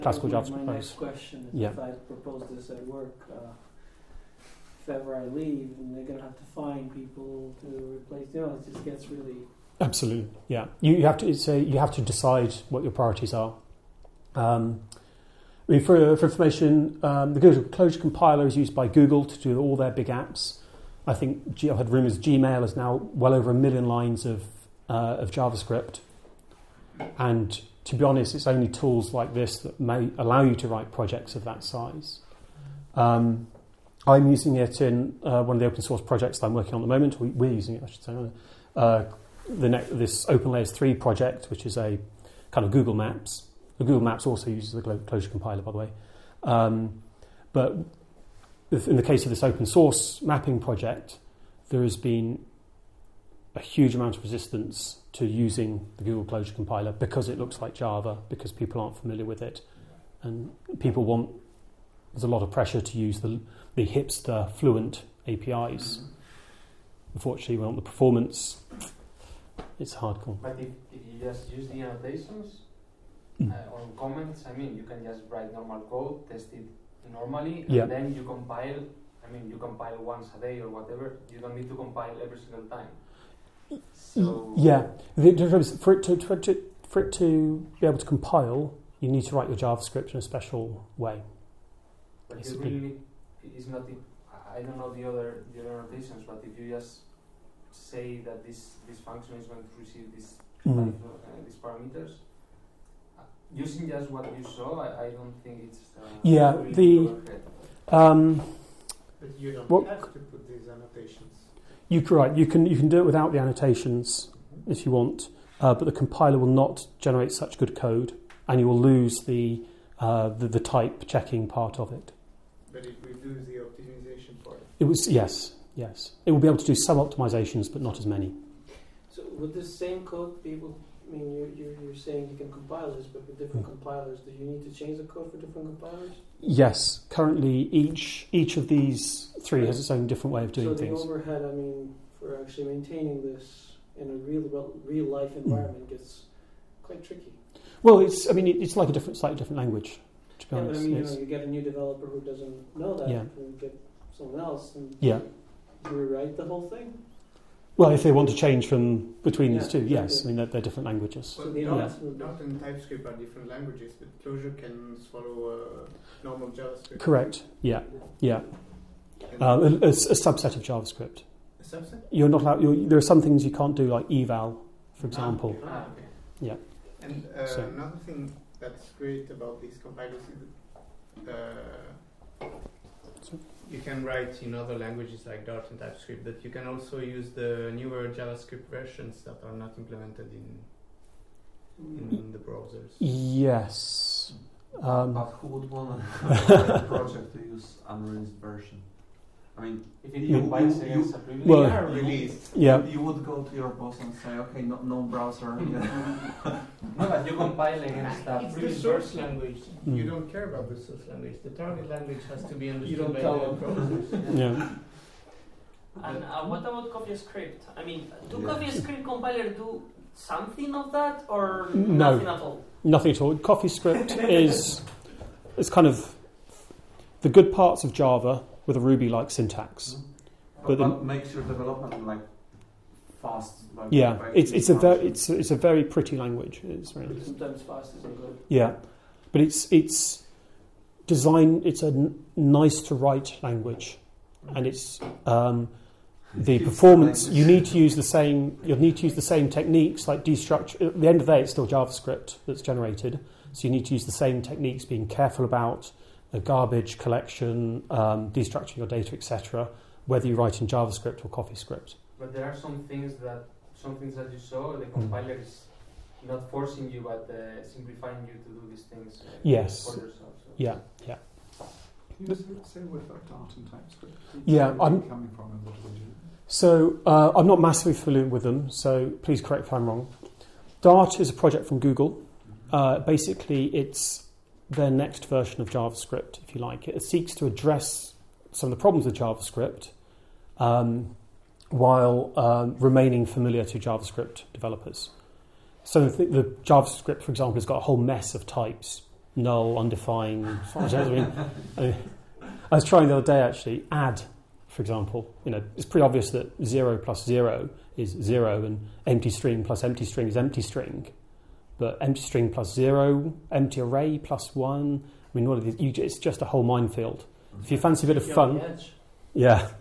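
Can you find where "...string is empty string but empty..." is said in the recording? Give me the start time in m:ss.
5:10.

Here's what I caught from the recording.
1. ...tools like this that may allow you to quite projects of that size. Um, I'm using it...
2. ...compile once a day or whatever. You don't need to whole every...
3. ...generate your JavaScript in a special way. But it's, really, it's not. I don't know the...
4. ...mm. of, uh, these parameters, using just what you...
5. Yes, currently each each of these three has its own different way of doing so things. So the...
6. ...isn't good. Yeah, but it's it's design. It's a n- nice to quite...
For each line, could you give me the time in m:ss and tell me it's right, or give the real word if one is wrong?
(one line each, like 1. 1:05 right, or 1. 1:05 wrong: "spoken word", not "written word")
1. 0:28 wrong: "write", not "quite"
2. 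1:19 wrong: "compile", not "whole"
3. 1:29 wrong: "write", not "generate"
4. 1:40 right
5. 2:16 right
6. 3:57 wrong: "write", not "quite".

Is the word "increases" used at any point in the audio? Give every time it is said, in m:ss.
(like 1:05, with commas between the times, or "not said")
not said.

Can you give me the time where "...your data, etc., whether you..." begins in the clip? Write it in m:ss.
4:18.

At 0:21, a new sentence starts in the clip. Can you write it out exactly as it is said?
I think i I've had rumors Gmail is now well over a million lines of, uh, of JavaScript.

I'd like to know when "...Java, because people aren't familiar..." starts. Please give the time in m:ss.
0:57.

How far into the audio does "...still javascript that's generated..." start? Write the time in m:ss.
4:11.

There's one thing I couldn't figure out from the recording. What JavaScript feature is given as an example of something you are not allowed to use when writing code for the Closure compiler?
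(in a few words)
eval.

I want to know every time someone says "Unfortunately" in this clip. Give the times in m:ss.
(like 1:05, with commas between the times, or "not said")
1:07.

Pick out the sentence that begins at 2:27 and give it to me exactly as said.
Well, it's I mean, it's like a different slightly different language.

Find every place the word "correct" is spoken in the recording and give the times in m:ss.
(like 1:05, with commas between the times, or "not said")
2:46, 4:39.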